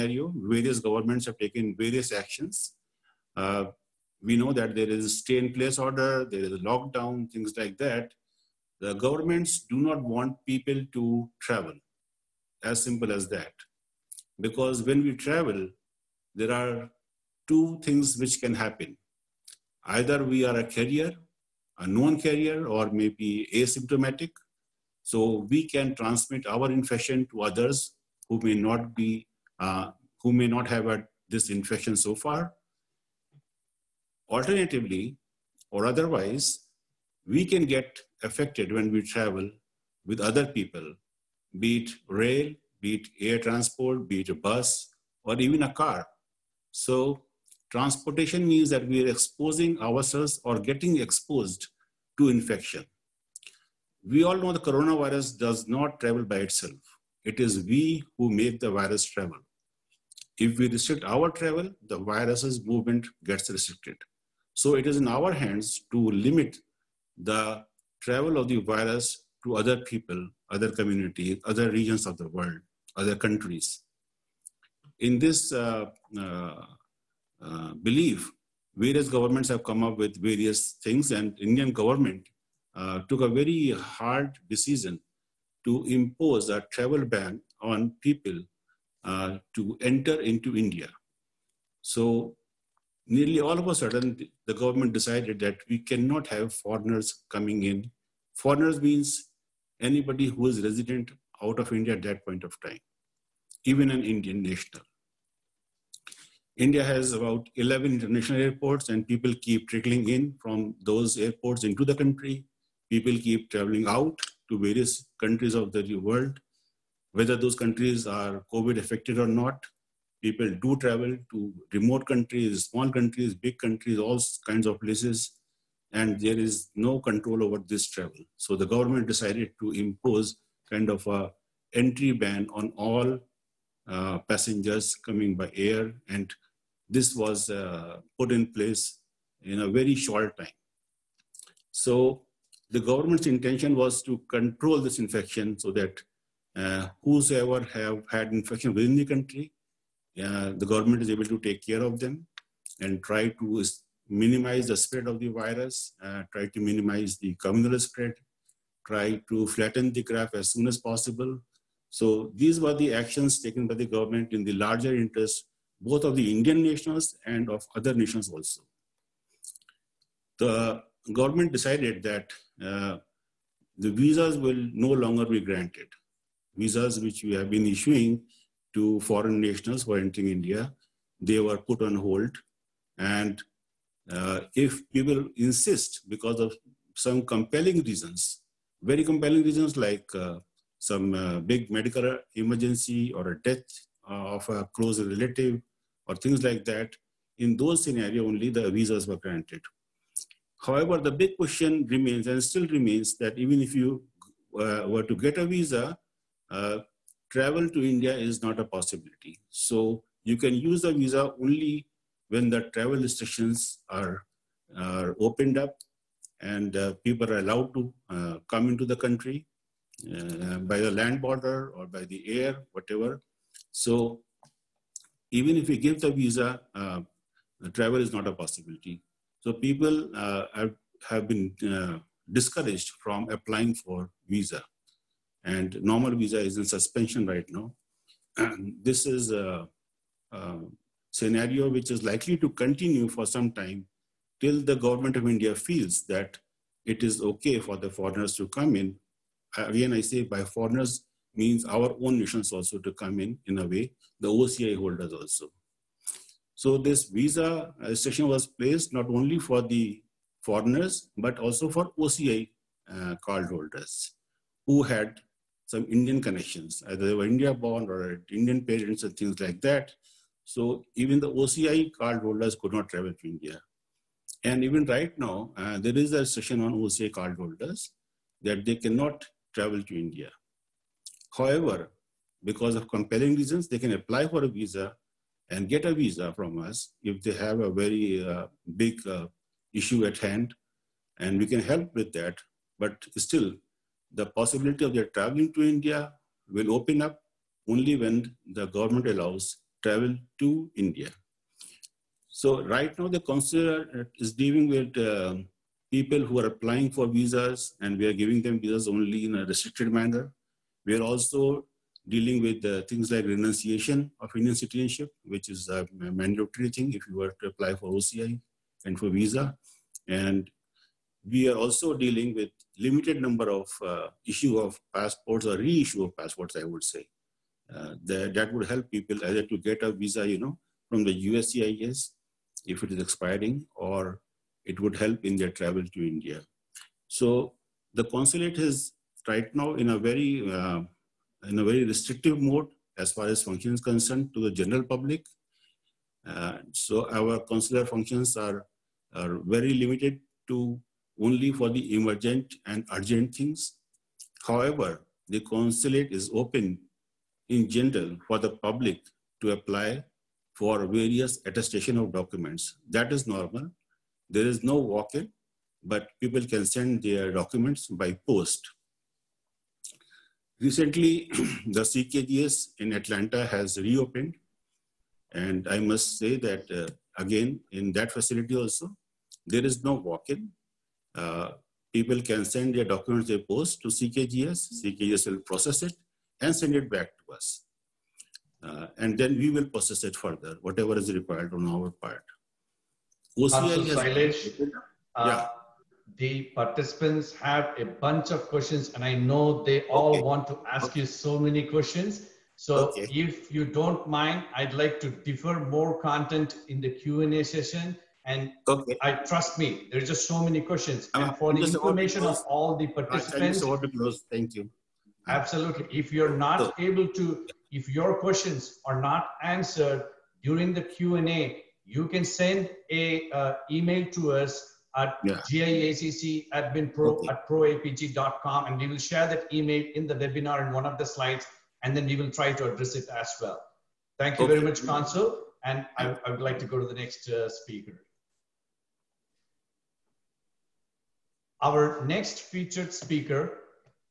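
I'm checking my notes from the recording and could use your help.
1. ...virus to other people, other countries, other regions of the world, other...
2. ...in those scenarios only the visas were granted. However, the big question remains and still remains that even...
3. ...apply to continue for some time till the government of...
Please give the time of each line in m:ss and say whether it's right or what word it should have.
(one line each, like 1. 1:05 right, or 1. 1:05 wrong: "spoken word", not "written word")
1. 1:08 wrong: "communities", not "countries"
2. 3:17 right
3. 4:02 wrong: "likely", not "apply".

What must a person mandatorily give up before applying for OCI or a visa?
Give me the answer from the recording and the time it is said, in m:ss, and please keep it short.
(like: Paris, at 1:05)
Indian citizenship, at 5:13.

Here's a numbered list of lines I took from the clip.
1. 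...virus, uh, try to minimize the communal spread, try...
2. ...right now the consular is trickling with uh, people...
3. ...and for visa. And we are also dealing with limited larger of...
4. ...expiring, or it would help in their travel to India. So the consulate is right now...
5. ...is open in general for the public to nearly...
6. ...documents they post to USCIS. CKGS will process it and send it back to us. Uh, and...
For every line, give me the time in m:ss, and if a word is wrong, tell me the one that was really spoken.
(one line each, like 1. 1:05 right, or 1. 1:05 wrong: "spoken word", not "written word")
1. 2:35 right
2. 5:02 wrong: "dealing", not "trickling"
3. 5:18 wrong: "number", not "larger"
4. 5:32 right
5. 5:56 wrong: "apply", not "nearly"
6. 6:22 wrong: "CKGS", not "USCIS".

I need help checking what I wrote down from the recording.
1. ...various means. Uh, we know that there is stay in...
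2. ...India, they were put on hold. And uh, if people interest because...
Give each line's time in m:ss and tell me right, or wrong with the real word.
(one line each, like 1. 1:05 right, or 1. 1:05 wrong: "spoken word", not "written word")
1. 0:01 wrong: "actions", not "means"
2. 3:00 wrong: "insist", not "interest".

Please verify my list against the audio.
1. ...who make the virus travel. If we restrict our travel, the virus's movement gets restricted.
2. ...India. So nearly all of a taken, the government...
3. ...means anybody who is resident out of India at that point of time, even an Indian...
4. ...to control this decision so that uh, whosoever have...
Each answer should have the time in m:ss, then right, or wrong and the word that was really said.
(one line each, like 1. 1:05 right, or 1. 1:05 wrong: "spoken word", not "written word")
1. 0:58 right
2. 1:30 wrong: "sudden", not "taken"
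3. 1:38 right
4. 2:24 wrong: "infection", not "decision".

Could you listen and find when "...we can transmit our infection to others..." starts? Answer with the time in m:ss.
0:25.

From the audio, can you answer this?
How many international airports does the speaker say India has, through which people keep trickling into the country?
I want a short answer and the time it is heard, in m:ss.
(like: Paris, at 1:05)
11, at 1:47.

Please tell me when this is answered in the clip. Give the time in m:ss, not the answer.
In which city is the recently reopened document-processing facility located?
6:12.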